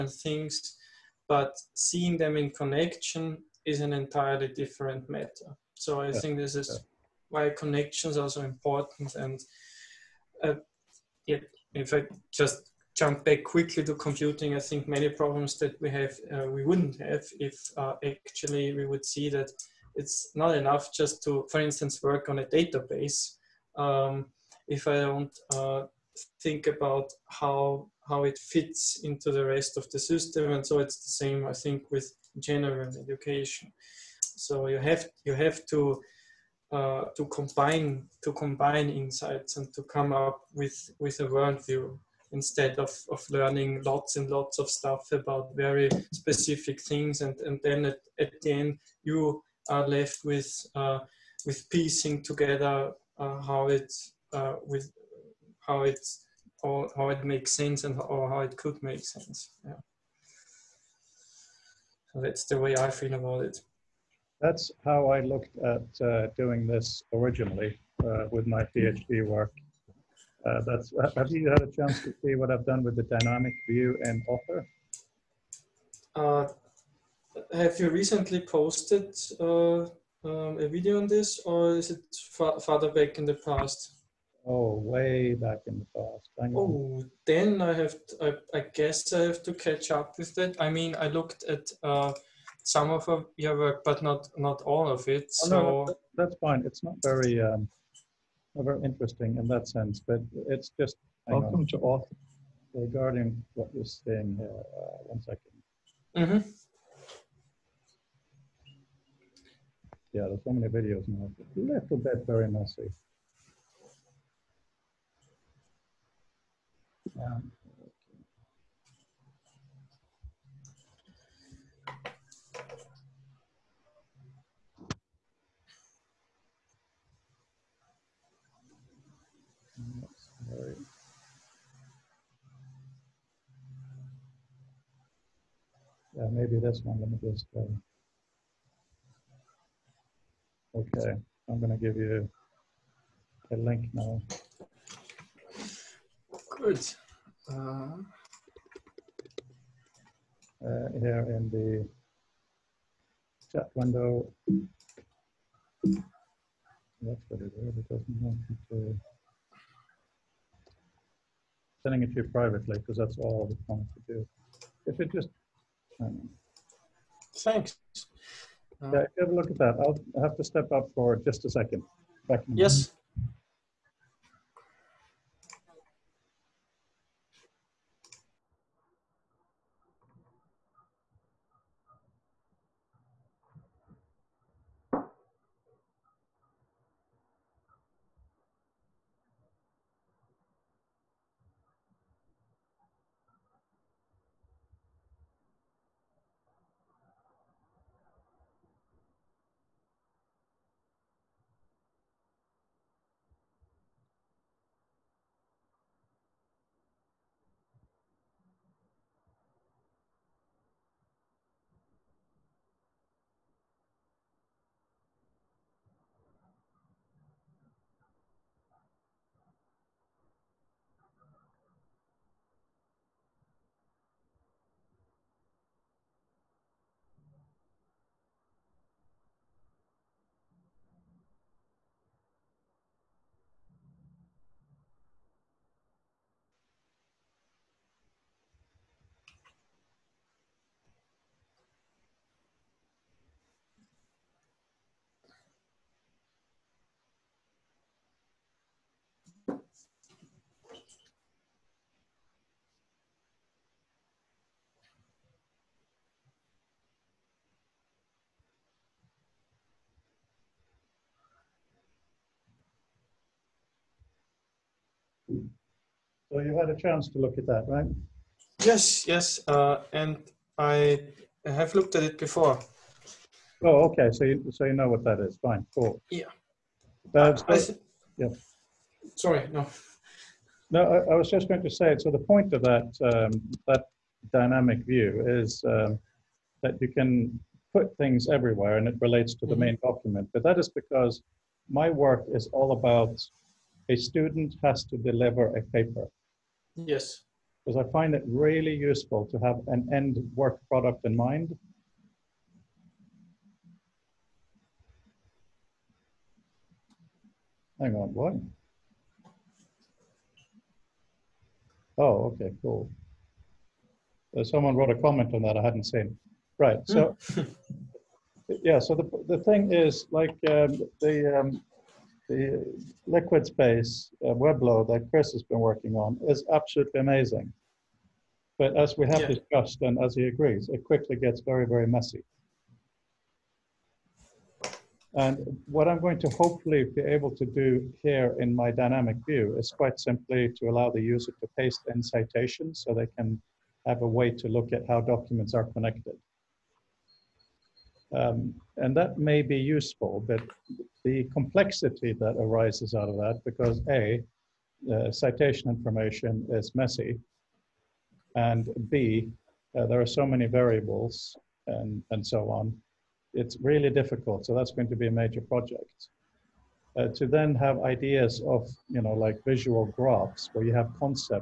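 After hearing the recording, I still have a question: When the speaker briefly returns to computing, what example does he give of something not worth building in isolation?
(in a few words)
a database.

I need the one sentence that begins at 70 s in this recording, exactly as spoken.
Uh, that's have you had a chance to see what I've done with the dynamic view and Author?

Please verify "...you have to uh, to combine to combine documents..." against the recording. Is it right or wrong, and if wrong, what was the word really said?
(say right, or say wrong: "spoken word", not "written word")
wrong: "insights", not "documents".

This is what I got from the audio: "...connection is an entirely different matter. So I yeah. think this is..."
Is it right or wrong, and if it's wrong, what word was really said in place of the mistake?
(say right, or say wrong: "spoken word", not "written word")
right.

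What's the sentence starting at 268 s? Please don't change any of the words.
Yes, yes, uh, and I have looked at it before.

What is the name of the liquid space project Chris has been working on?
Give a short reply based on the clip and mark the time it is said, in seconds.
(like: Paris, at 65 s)
Webleau, at 324 s.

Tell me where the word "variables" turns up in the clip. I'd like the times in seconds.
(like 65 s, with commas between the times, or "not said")
360 s.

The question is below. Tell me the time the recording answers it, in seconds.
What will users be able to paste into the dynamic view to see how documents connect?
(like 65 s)
342 s.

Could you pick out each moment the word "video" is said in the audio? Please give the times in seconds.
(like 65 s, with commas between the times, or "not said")
80 s, 110 s.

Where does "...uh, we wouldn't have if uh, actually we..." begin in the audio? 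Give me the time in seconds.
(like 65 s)
16 s.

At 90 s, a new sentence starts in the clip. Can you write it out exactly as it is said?
I mean, I looked at uh, some of your work, but not not all of it.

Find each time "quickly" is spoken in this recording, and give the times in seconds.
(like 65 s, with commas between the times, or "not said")
13 s, 330 s.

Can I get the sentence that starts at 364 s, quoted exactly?
So that's going to be a major project.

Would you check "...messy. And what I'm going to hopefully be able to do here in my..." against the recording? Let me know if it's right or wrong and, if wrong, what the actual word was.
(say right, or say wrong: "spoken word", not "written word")
right.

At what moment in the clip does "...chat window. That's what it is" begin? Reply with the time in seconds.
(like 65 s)
153 s.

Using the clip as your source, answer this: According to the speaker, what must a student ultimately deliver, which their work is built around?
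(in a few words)
A paper.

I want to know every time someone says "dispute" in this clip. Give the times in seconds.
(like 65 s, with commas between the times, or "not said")
not said.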